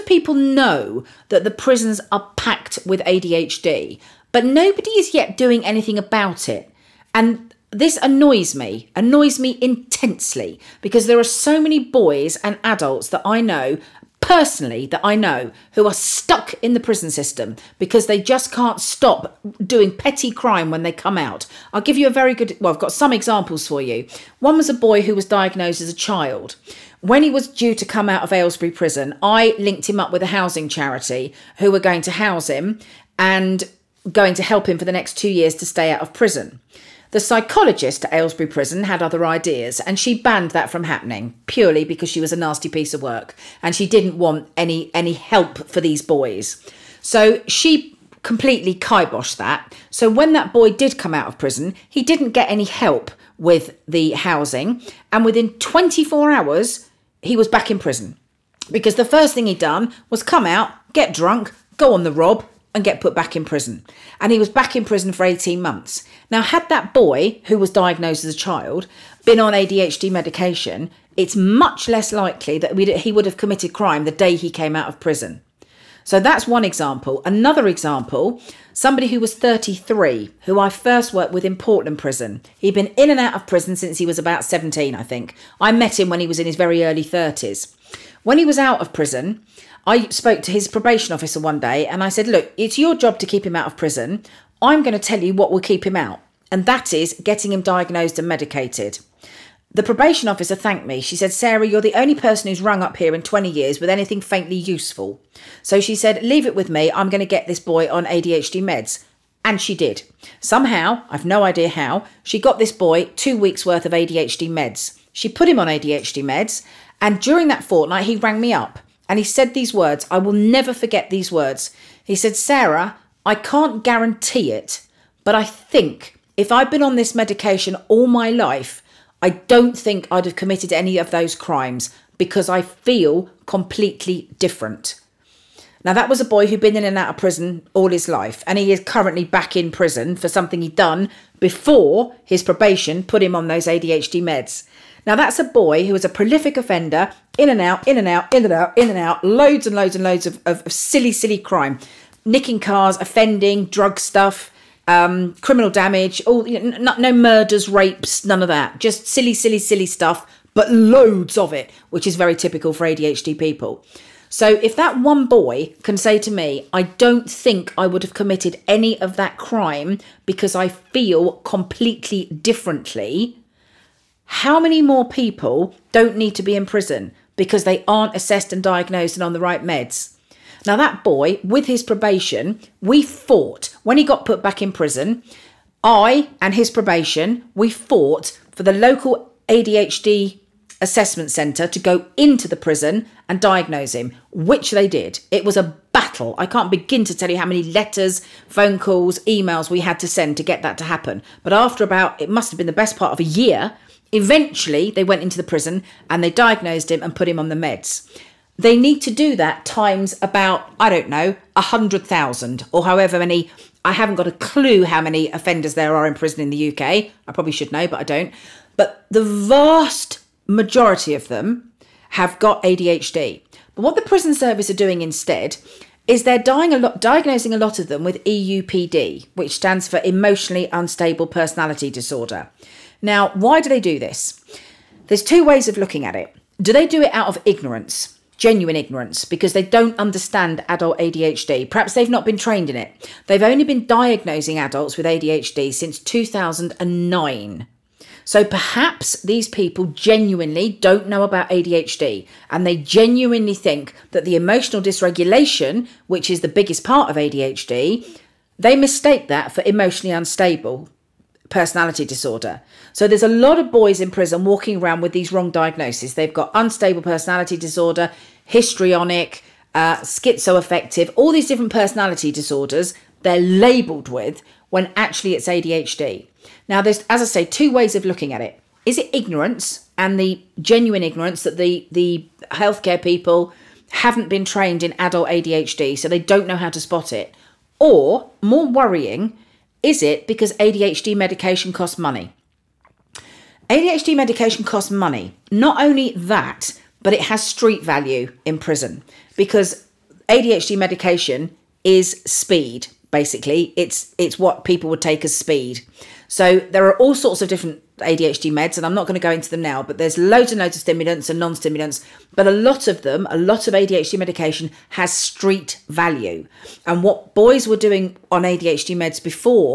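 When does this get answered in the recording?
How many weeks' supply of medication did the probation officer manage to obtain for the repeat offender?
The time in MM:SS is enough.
01:53.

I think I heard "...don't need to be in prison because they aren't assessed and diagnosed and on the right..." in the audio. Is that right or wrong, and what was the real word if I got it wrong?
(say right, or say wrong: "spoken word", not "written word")
right.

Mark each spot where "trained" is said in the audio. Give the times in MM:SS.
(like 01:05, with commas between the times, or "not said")
04:02, 04:44.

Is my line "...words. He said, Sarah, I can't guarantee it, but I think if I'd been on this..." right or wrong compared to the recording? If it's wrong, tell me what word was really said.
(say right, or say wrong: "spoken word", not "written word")
right.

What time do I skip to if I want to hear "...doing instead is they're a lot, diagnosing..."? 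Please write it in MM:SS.
03:44.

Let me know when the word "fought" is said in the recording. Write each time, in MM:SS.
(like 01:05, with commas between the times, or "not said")
03:03, 03:07.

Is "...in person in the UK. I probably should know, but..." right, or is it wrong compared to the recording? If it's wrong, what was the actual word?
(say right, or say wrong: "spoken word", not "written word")
wrong: "prison", not "person".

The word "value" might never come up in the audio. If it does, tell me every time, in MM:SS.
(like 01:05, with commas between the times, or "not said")
04:57, 05:15.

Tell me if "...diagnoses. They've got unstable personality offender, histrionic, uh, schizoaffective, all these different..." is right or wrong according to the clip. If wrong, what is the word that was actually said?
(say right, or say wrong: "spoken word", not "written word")
wrong: "disorder", not "offender".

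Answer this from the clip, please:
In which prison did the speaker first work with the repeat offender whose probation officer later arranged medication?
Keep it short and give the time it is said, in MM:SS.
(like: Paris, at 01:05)
Portland prison, at 01:21.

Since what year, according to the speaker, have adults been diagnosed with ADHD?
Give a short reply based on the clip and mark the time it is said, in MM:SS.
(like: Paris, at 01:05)
2009, at 04:05.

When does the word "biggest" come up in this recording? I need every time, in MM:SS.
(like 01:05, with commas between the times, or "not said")
04:16.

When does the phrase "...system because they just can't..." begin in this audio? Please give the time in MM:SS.
00:17.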